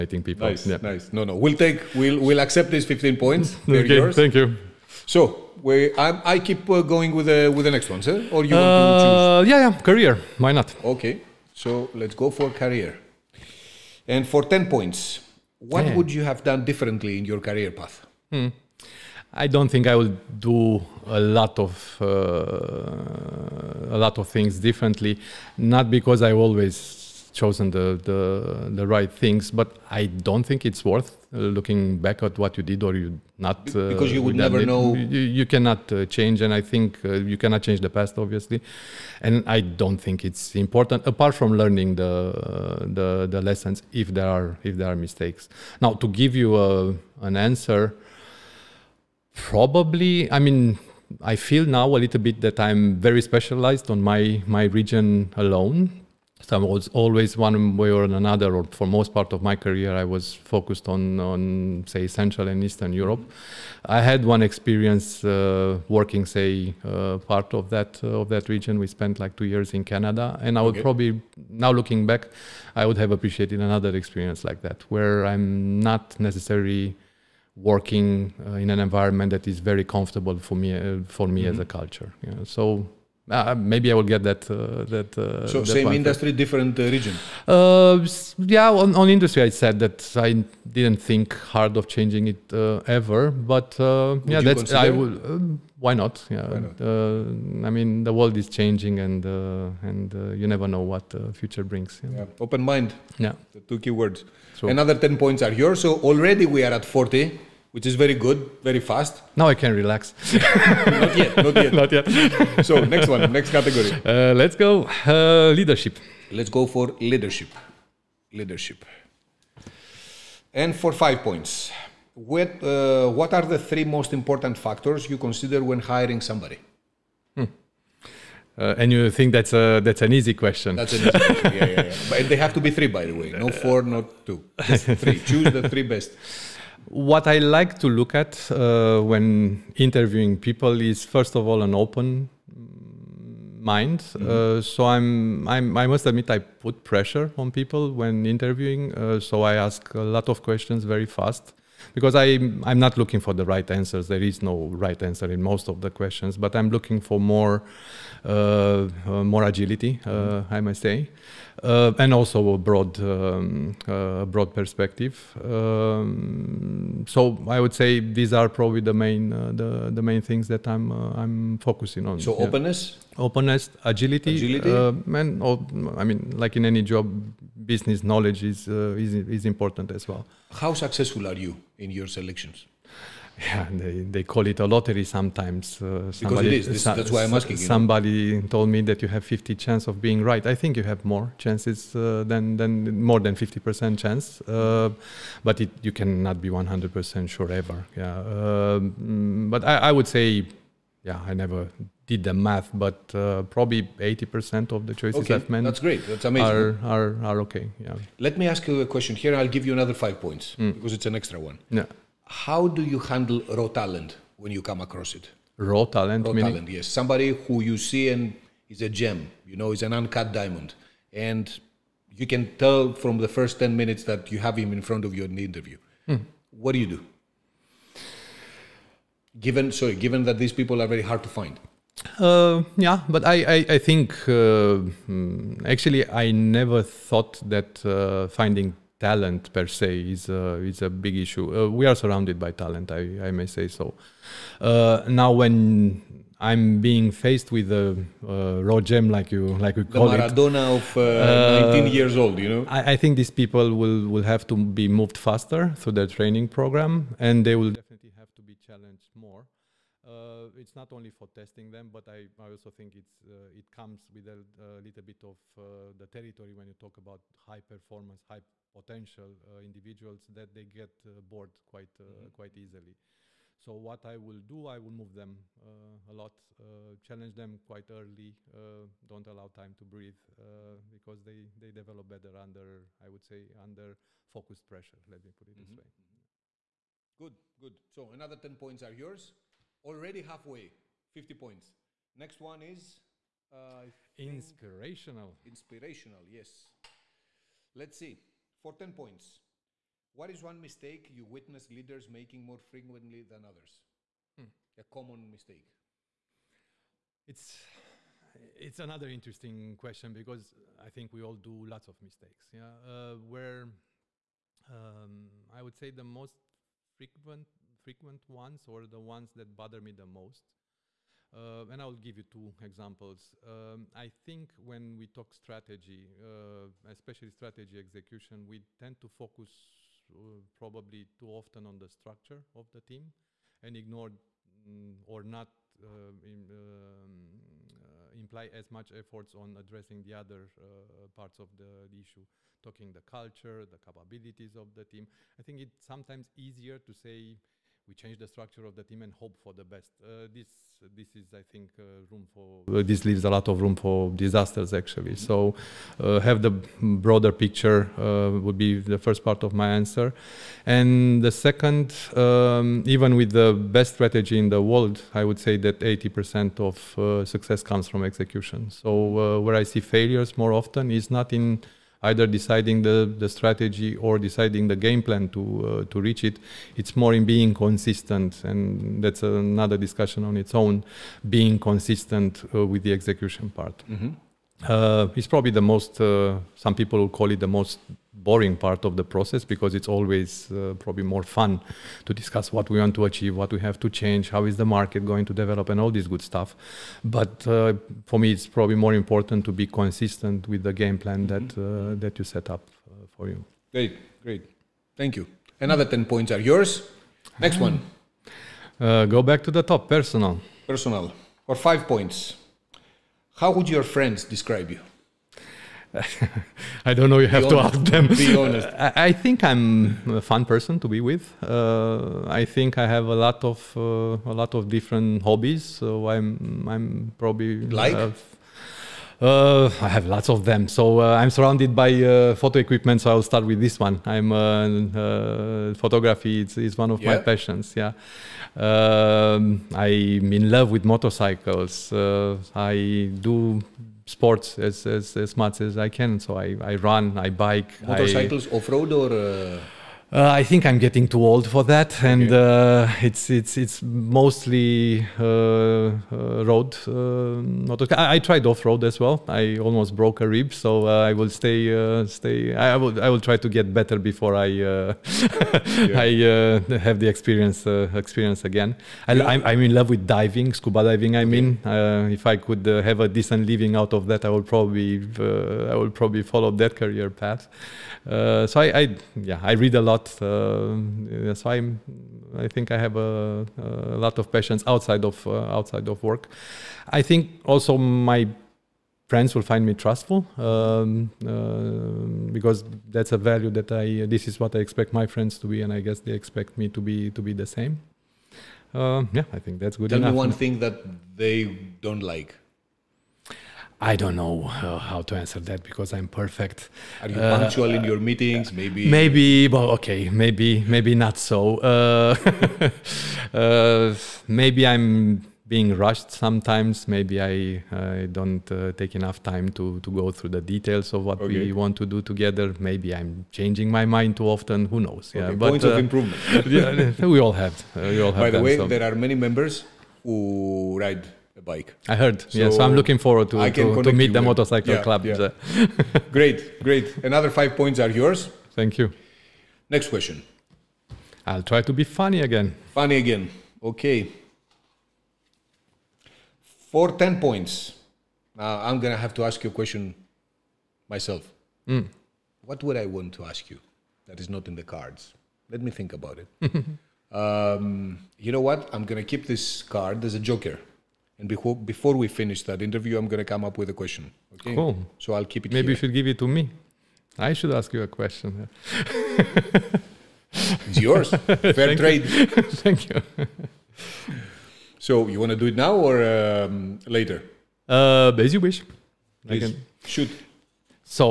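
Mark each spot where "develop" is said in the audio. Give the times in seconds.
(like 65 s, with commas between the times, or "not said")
281 s, 395 s.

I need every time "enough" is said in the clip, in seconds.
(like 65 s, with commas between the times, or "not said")
499 s, 518 s.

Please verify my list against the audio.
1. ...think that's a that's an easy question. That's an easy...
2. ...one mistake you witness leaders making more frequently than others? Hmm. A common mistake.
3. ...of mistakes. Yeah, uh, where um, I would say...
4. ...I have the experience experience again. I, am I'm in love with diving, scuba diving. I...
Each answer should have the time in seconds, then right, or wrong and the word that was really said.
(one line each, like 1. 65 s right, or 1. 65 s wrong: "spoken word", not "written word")
1. 129 s right
2. 300 s right
3. 311 s right
4. 465 s right.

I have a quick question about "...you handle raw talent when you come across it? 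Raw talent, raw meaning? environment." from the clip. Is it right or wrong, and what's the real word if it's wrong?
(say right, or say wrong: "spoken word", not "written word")
wrong: "talent", not "environment".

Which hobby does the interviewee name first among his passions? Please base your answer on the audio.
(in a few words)
Photography.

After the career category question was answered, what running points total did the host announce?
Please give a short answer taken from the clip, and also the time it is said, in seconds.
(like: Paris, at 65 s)
40, at 106 s.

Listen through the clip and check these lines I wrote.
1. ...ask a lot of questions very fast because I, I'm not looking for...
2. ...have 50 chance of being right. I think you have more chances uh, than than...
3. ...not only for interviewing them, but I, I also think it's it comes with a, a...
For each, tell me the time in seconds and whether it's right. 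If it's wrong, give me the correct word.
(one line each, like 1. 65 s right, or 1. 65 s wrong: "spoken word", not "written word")
1. 149 s right
2. 189 s right
3. 260 s wrong: "testing", not "interviewing".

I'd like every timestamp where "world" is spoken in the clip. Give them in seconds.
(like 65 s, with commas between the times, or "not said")
98 s, 364 s.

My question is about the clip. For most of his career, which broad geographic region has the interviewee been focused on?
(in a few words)
Central and Eastern Europe.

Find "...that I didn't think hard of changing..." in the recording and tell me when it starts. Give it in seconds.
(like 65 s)
89 s.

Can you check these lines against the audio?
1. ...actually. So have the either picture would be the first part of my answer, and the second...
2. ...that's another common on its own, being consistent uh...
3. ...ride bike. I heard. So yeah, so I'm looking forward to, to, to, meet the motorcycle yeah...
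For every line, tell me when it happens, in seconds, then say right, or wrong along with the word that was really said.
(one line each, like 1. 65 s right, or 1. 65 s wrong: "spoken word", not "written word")
1. 354 s wrong: "broader", not "either"
2. 379 s wrong: "discussion", not "common"
3. 530 s right.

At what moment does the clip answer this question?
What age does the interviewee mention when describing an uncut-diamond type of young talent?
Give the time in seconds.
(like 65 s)
251 s.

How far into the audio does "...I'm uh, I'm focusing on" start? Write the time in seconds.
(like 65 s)
170 s.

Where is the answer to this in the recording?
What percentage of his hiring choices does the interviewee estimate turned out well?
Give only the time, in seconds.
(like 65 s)
203 s.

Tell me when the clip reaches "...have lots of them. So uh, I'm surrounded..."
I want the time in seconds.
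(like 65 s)
429 s.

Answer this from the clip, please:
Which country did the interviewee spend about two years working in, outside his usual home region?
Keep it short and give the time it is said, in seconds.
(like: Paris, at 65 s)
Canada, at 69 s.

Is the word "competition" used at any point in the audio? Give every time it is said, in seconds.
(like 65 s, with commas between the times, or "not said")
not said.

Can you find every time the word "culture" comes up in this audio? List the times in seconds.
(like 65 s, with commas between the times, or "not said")
81 s, 343 s.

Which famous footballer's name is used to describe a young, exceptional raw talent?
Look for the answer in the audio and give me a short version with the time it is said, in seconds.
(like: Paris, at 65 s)
Maradona, at 250 s.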